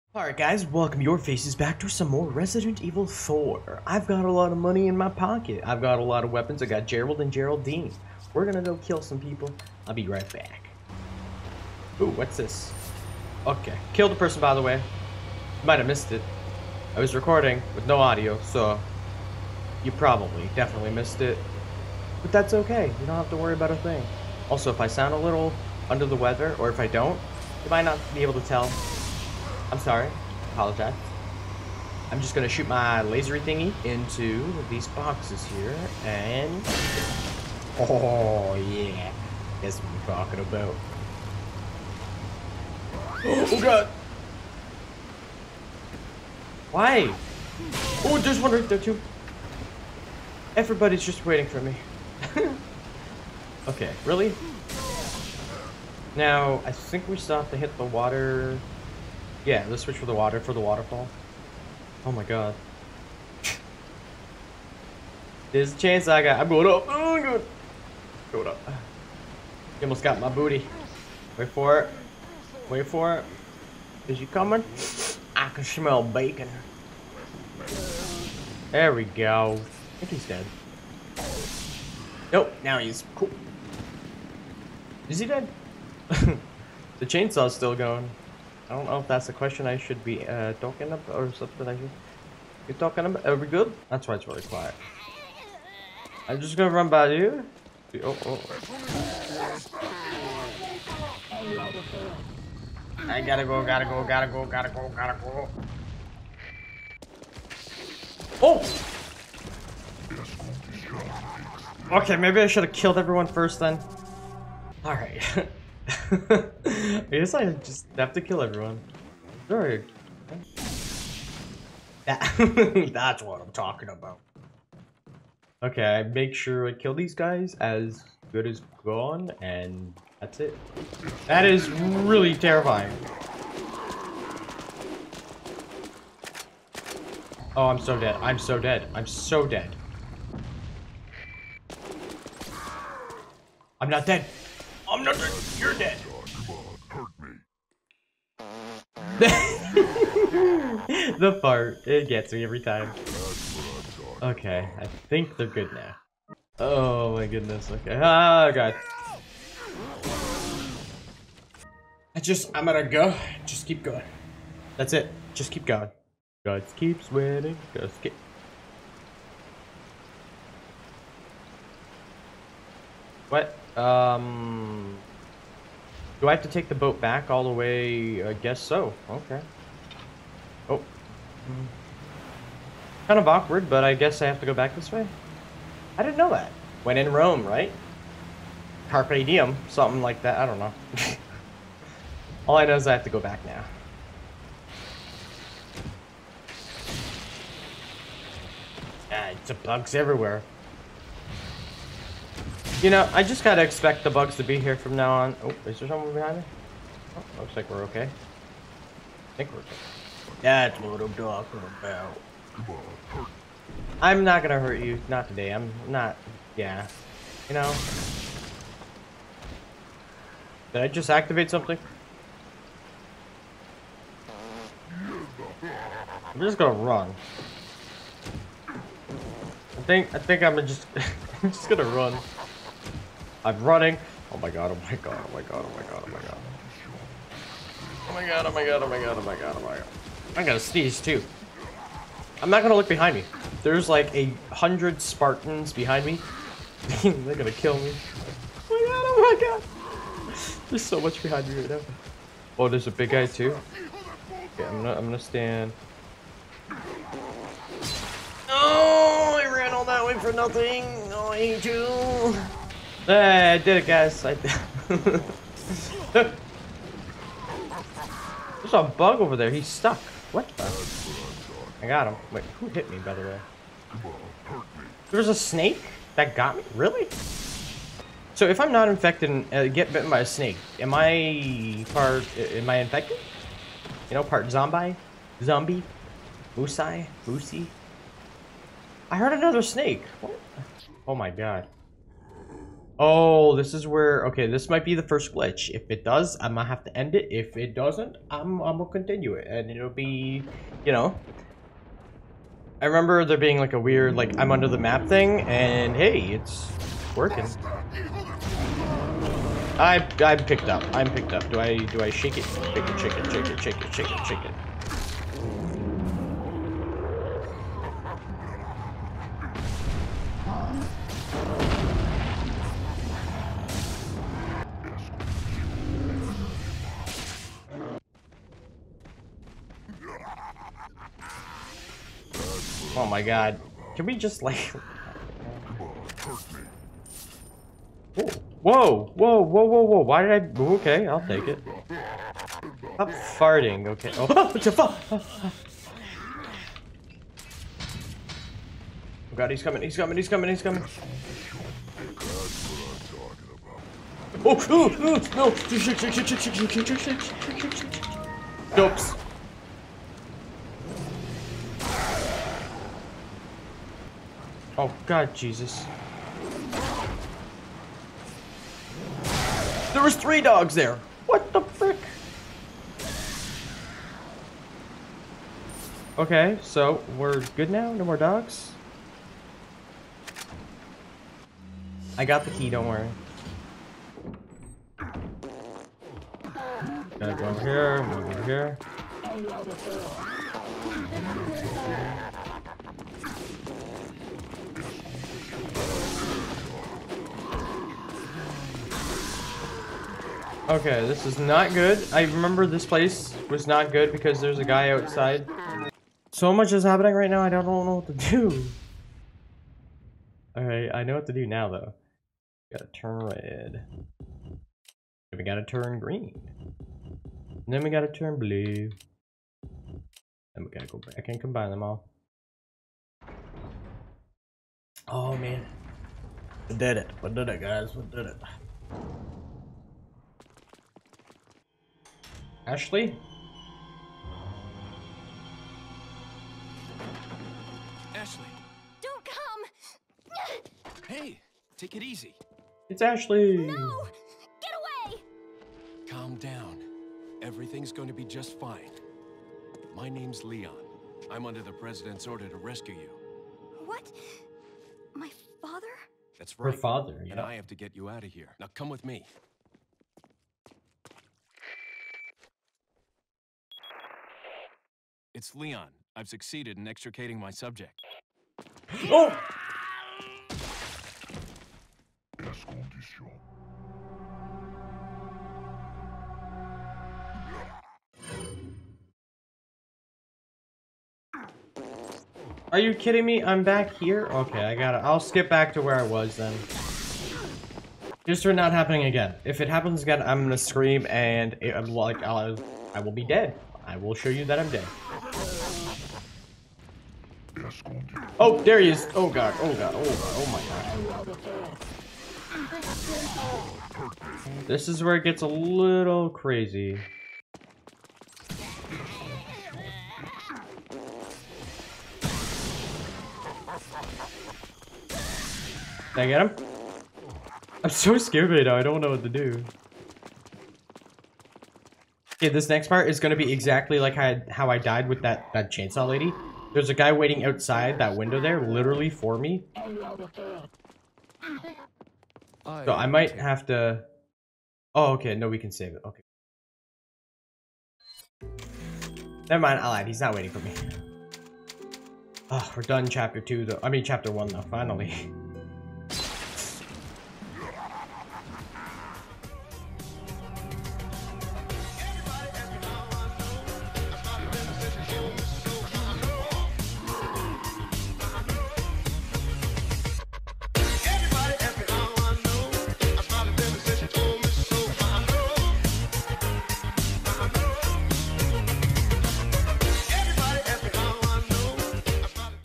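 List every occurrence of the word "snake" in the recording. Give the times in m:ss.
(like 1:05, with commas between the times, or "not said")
4:35, 4:40, 4:49.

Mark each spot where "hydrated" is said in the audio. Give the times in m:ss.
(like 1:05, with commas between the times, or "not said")
not said.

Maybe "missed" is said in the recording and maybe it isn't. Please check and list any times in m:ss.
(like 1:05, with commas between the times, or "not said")
0:15, 0:20.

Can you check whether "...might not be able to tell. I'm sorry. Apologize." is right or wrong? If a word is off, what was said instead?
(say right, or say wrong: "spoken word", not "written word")
right.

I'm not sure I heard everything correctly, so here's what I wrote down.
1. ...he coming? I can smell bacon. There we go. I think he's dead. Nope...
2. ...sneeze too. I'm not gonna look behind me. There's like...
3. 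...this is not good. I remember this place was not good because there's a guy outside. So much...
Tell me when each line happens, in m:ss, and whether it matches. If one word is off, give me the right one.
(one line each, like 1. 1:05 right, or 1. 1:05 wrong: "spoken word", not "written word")
1. 1:14 right
2. 4:00 right
3. 6:41 right.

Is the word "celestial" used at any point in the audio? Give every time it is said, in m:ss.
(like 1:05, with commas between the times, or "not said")
not said.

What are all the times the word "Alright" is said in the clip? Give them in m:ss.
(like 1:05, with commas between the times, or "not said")
0:00, 1:54, 6:50.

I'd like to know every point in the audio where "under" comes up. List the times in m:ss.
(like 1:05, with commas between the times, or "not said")
0:25, 5:04, 7:31.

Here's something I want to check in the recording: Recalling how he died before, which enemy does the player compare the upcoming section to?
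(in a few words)
chainsaw lady.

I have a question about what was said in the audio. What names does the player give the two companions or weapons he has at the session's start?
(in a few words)
Gerald and Geraldine.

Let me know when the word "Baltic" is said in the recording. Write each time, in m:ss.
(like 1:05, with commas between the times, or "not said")
not said.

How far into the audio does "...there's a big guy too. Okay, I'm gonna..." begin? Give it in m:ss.
4:12.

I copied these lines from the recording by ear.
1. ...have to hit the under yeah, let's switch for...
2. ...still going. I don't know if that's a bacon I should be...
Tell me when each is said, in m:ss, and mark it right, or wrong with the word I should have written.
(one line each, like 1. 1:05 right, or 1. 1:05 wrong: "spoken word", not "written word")
1. 0:57 wrong: "water", not "under"
2. 1:27 wrong: "question", not "bacon".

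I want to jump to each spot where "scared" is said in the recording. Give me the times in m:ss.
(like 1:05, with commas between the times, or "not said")
8:38.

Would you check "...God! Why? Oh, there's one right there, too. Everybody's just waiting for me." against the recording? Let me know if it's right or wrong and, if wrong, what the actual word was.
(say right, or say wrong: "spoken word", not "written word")
right.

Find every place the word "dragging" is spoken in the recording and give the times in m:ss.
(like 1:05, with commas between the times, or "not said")
not said.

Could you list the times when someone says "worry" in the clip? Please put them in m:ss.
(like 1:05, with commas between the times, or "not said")
0:23, 6:22.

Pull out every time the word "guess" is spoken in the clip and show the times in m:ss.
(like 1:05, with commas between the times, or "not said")
1:57, 2:58, 3:03.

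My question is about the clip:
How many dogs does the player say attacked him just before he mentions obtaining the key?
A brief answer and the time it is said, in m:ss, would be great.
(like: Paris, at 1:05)
3, at 6:10.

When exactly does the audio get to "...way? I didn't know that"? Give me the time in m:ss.
3:04.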